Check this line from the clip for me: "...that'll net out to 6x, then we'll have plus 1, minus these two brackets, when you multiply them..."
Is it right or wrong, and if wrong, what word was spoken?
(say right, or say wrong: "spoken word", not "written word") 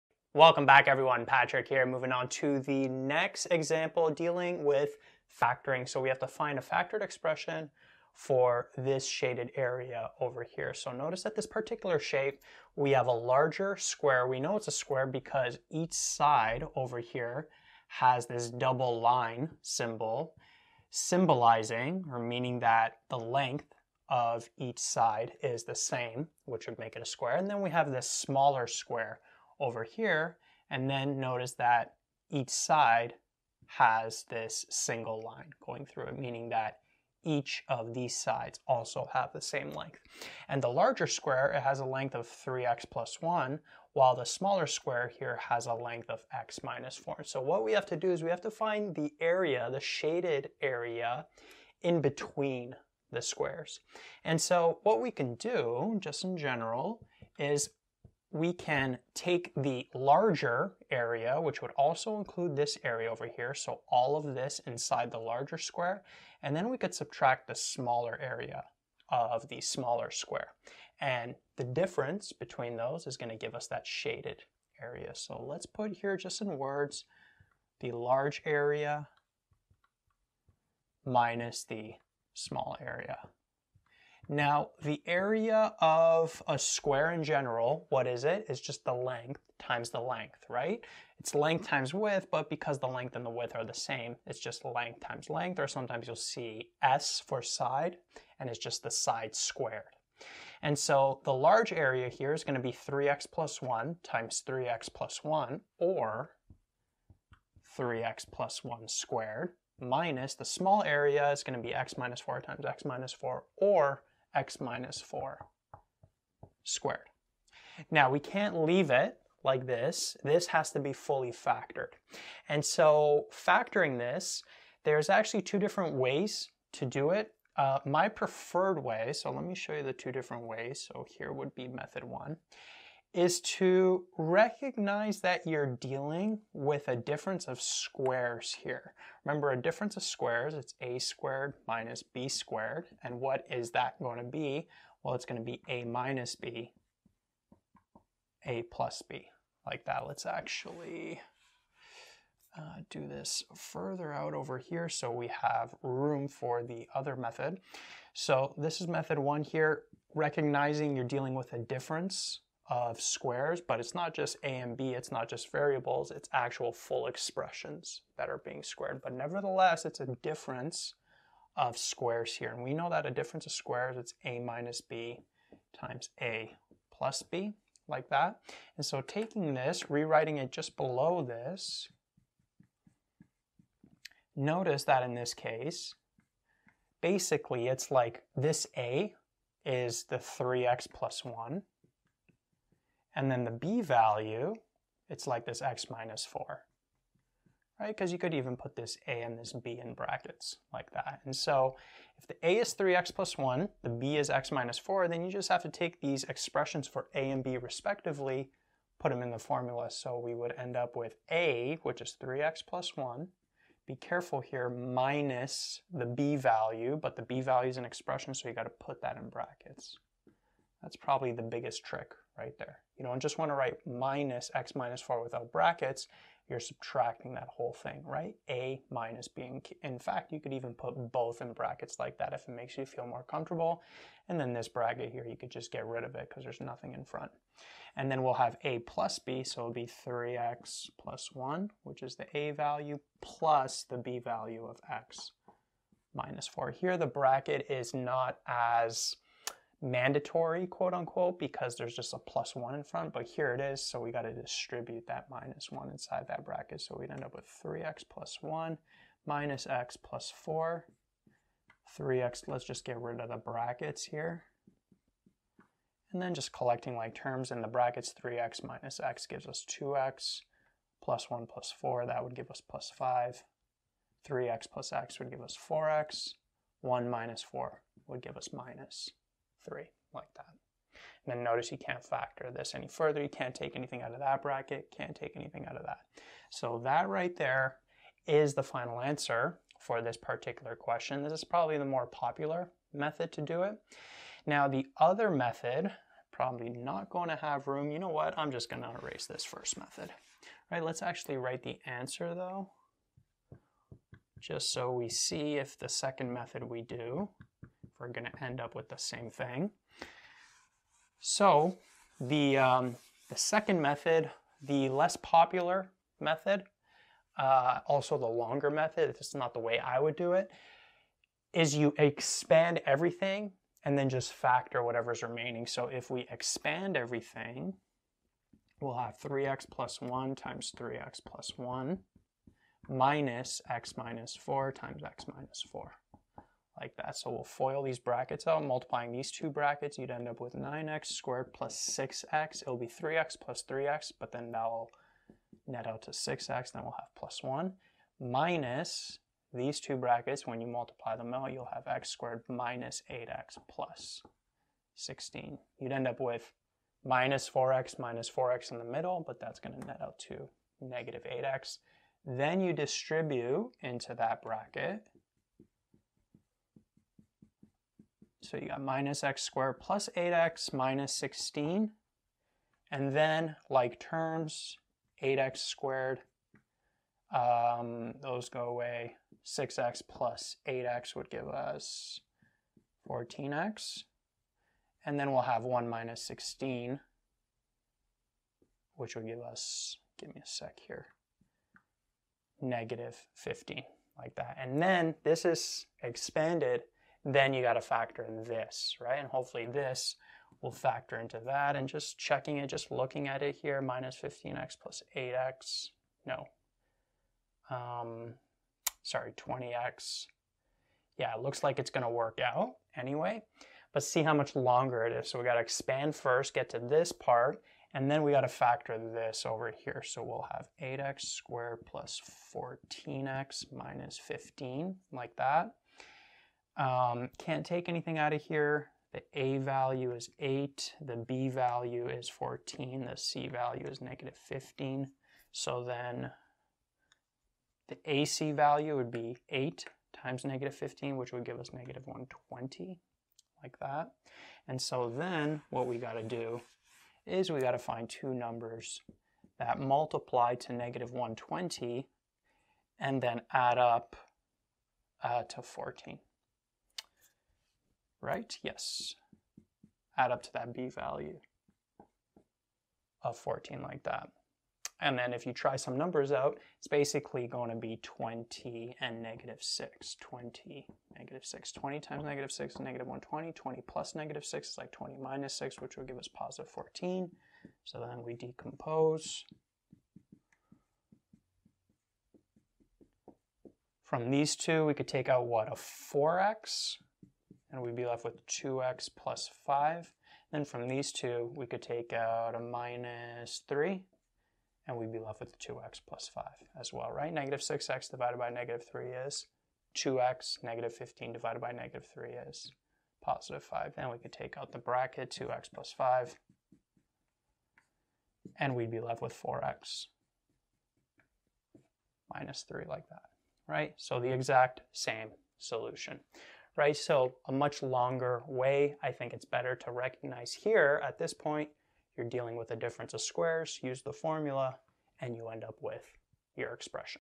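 right.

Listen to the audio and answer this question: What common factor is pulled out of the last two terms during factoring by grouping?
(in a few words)
-3.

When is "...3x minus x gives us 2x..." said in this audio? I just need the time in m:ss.
4:28.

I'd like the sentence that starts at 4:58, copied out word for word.
I'm just going to erase this first method.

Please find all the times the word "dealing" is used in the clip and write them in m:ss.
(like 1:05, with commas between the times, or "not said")
0:04, 2:15, 2:41, 8:42.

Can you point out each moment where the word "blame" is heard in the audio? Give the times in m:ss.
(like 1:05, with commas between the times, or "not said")
not said.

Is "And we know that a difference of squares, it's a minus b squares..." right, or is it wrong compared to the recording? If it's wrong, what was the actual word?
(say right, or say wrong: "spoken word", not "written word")
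wrong: "times", not "squares".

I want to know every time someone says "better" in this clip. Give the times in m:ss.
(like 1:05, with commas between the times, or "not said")
8:39.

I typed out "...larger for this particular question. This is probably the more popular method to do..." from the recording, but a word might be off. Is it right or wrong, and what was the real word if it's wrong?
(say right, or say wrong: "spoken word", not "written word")
wrong: "answer", not "larger".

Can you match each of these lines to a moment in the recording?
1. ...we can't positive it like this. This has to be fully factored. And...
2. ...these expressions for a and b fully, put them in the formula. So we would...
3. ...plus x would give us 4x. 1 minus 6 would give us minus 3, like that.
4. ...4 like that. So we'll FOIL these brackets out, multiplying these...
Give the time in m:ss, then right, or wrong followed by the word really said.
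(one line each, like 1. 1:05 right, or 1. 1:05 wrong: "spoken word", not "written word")
1. 1:58 wrong: "leave", not "positive"
2. 3:25 wrong: "respectively", not "fully"
3. 4:34 wrong: "4", not "6"
4. 5:35 right.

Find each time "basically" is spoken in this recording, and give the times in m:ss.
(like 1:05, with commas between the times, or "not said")
3:07, 7:46.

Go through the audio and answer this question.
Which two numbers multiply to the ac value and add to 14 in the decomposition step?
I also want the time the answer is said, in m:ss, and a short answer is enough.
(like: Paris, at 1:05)
20 and -6, at 7:48.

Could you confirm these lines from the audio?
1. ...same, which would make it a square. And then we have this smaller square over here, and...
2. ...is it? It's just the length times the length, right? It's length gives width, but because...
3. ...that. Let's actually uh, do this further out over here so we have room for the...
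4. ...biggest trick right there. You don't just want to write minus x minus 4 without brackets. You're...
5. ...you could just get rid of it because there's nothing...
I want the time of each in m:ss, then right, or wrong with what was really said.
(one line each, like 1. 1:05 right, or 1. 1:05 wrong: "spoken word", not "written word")
1. 0:25 right
2. 1:28 wrong: "times", not "gives"
3. 2:29 right
4. 3:41 right
5. 3:55 right.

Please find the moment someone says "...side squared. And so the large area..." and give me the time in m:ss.
1:38.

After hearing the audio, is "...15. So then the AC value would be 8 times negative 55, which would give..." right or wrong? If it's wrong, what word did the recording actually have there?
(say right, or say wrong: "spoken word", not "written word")
wrong: "15", not "55".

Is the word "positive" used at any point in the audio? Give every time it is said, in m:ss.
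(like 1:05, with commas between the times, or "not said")
7:56, 8:23.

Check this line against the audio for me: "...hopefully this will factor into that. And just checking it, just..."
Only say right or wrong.
right.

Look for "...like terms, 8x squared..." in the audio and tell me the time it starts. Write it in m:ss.
6:13.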